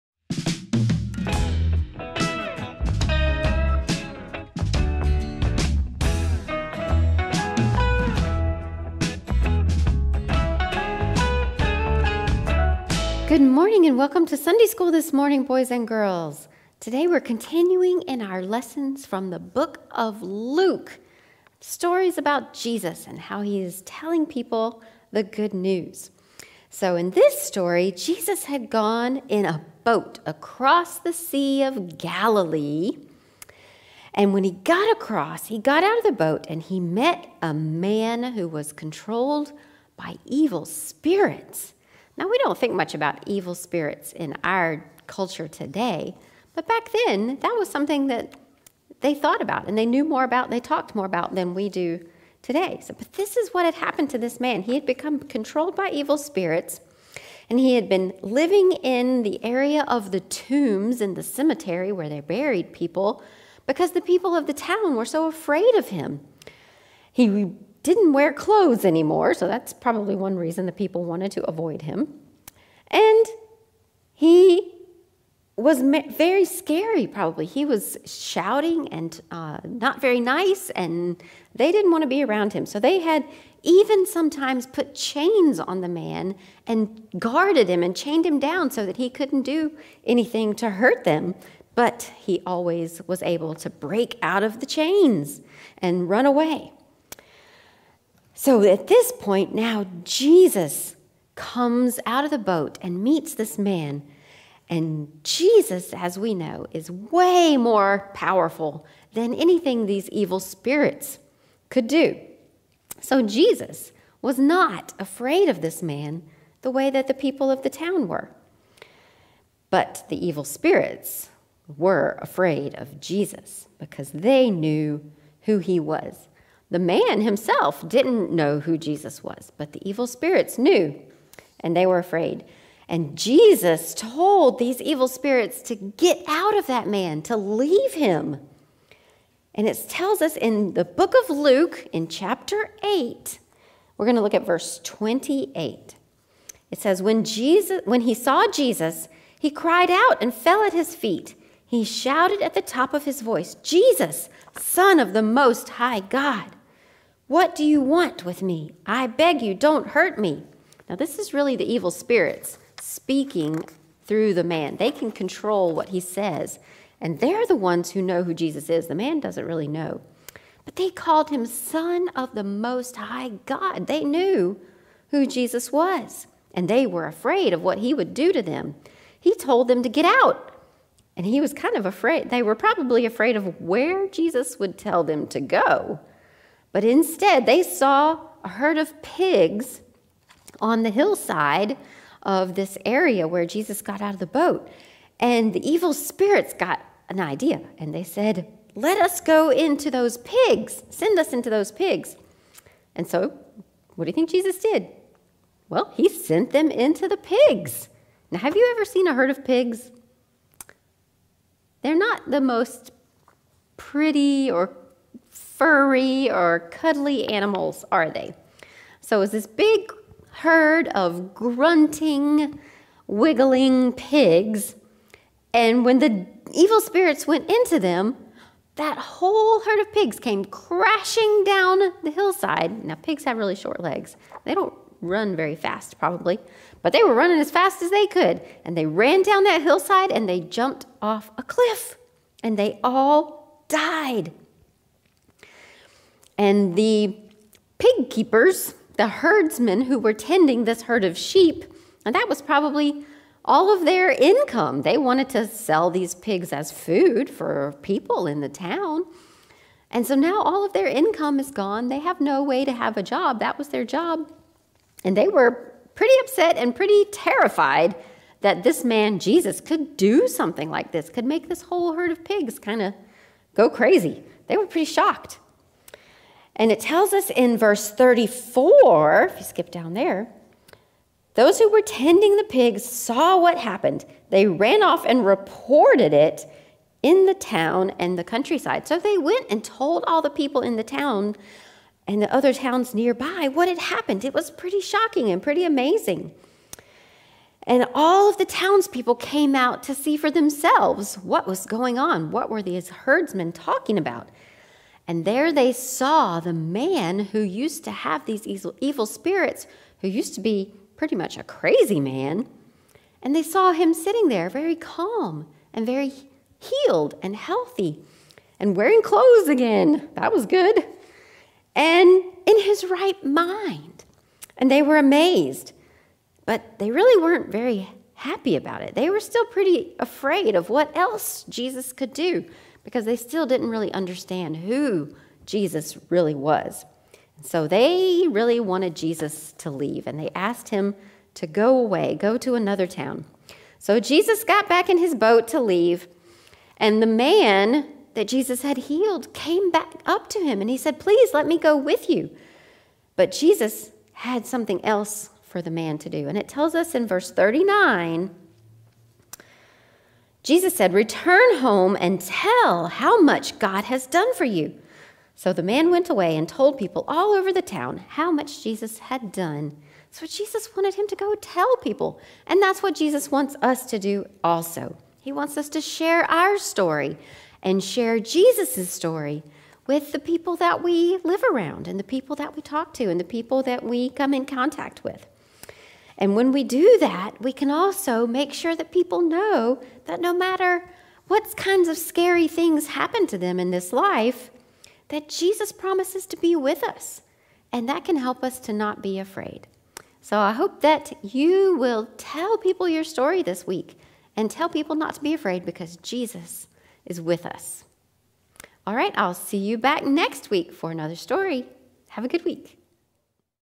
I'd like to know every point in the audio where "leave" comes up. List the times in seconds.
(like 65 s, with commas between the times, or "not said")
137 s, 339 s, 345 s.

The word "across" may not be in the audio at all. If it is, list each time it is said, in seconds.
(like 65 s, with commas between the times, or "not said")
30 s, 34 s.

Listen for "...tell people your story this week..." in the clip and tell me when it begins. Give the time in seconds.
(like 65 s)
402 s.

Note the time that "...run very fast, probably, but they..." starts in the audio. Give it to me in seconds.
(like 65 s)
234 s.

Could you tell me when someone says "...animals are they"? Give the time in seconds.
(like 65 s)
217 s.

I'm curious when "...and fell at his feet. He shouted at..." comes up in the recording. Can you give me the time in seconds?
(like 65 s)
150 s.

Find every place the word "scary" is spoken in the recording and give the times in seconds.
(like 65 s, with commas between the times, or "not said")
76 s, 391 s.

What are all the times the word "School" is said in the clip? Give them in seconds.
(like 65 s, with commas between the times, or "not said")
14 s.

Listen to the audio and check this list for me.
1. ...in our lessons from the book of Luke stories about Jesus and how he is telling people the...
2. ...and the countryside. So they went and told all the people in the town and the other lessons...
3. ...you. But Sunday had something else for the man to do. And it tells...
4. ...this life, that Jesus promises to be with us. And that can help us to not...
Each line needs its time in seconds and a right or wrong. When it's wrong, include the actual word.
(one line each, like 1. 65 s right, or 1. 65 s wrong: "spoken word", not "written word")
1. 18 s right
2. 287 s wrong: "towns", not "lessons"
3. 352 s wrong: "Jesus", not "Sunday"
4. 393 s right.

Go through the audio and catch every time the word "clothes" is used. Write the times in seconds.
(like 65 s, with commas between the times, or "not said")
68 s, 319 s.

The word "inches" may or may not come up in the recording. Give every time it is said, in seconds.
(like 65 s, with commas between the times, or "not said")
not said.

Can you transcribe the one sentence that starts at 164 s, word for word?
They can control what he says, and they're the ones who know who Jesus is.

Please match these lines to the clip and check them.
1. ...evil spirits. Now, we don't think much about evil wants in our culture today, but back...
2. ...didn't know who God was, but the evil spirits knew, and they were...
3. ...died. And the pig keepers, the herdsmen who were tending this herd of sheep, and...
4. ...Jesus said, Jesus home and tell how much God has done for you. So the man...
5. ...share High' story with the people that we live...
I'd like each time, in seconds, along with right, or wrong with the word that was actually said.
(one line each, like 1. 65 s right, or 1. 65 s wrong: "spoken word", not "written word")
1. 40 s wrong: "spirits", not "wants"
2. 127 s wrong: "Jesus", not "God"
3. 243 s right
4. 360 s wrong: "Return", not "Jesus"
5. 377 s wrong: "Jesus", not "High".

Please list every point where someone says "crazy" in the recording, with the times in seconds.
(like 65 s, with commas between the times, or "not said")
273 s, 311 s.